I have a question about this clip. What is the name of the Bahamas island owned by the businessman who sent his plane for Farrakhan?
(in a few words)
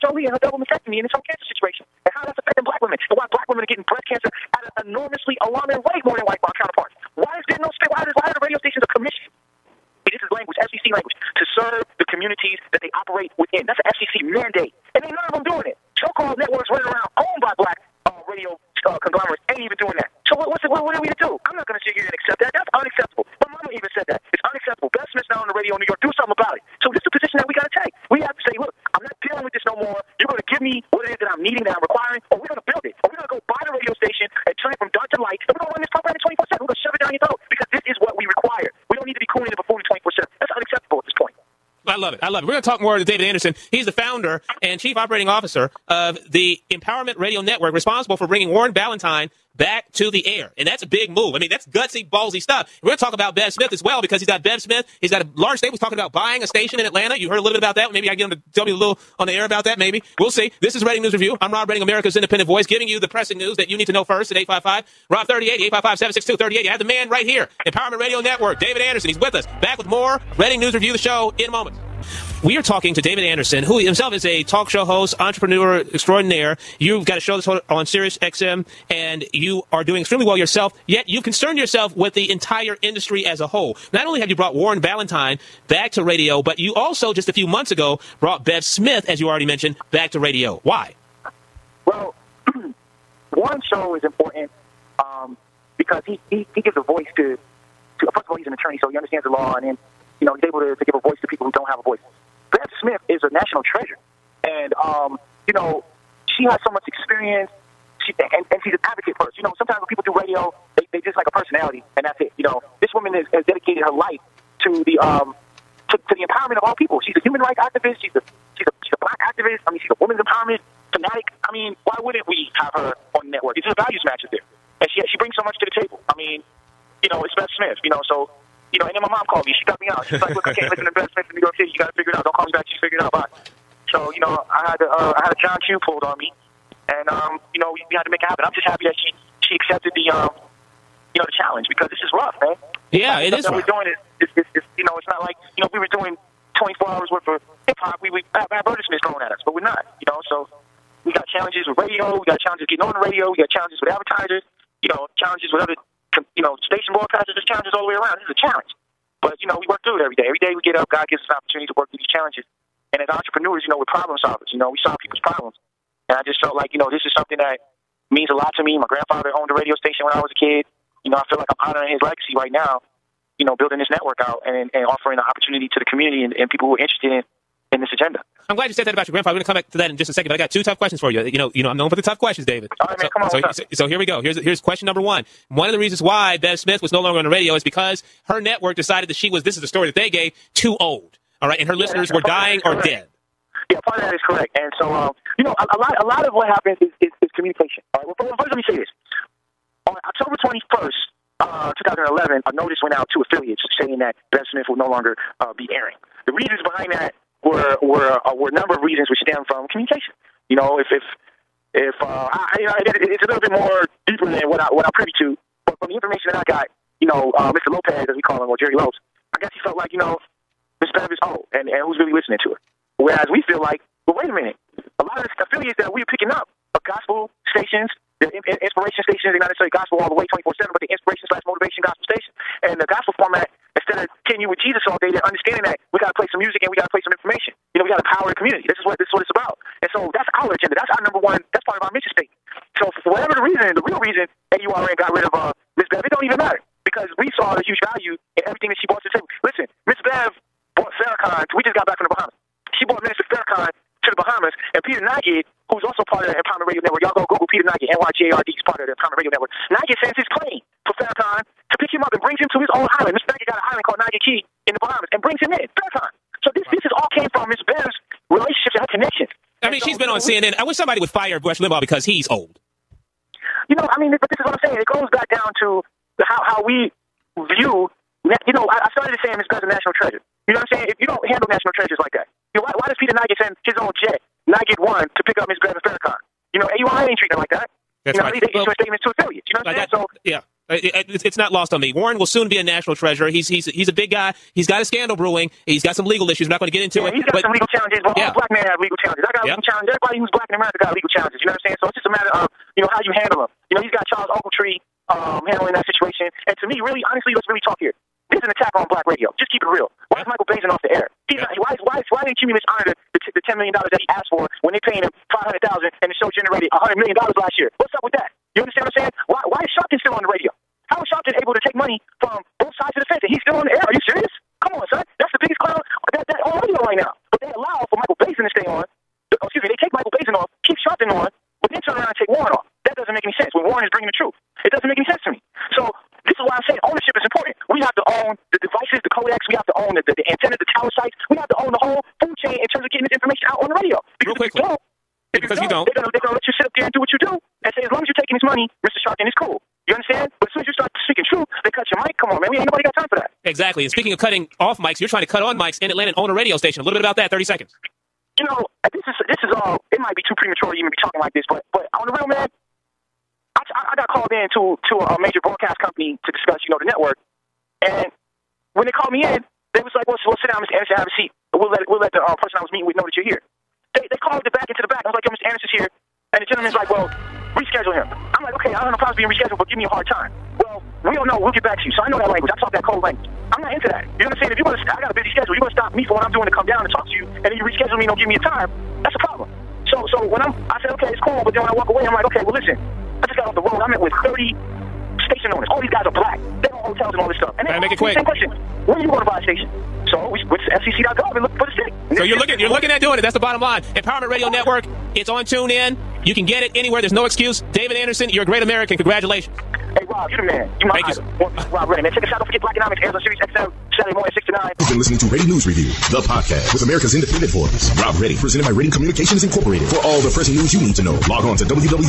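Nygard Cay.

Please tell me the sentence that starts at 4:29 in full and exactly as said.
I mean, so, she's been on CNN.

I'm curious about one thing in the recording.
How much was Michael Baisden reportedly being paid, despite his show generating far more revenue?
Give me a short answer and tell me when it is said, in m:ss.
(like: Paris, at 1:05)
500,000 dollars, at 5:15.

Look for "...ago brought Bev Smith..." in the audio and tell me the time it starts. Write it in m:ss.
1:27.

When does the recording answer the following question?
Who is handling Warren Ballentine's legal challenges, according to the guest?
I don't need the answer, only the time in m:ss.
5:04.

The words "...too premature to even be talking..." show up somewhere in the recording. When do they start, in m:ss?
6:00.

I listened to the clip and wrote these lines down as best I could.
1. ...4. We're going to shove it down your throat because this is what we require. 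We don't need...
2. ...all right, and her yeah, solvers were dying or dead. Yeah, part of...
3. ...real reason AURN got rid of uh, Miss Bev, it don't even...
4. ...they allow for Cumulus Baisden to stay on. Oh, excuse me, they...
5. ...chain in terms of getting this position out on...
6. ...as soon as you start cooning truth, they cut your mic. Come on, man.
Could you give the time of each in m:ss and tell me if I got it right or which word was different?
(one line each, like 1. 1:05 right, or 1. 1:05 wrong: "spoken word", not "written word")
1. 0:36 wrong: "7", not "4"
2. 3:11 wrong: "listeners", not "solvers"
3. 4:03 right
4. 5:27 wrong: "Michael", not "Cumulus"
5. 5:42 wrong: "information", not "position"
6. 5:50 wrong: "speaking", not "cooning".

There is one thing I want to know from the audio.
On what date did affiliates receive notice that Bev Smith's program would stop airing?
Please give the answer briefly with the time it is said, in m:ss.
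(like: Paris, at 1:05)
October 21, 2011, at 3:20.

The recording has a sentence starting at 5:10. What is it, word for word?
is Michael Baisden off the air?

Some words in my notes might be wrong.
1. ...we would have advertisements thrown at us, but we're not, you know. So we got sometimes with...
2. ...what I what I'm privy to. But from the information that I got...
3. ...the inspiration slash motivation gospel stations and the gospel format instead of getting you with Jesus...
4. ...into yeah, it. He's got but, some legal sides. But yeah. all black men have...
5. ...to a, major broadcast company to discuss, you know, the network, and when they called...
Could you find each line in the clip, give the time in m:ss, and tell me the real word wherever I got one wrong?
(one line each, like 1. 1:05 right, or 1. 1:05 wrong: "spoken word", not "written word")
1. 2:28 wrong: "challenges", not "sometimes"
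2. 3:34 right
3. 3:50 right
4. 4:56 wrong: "challenges", not "sides"
5. 6:04 right.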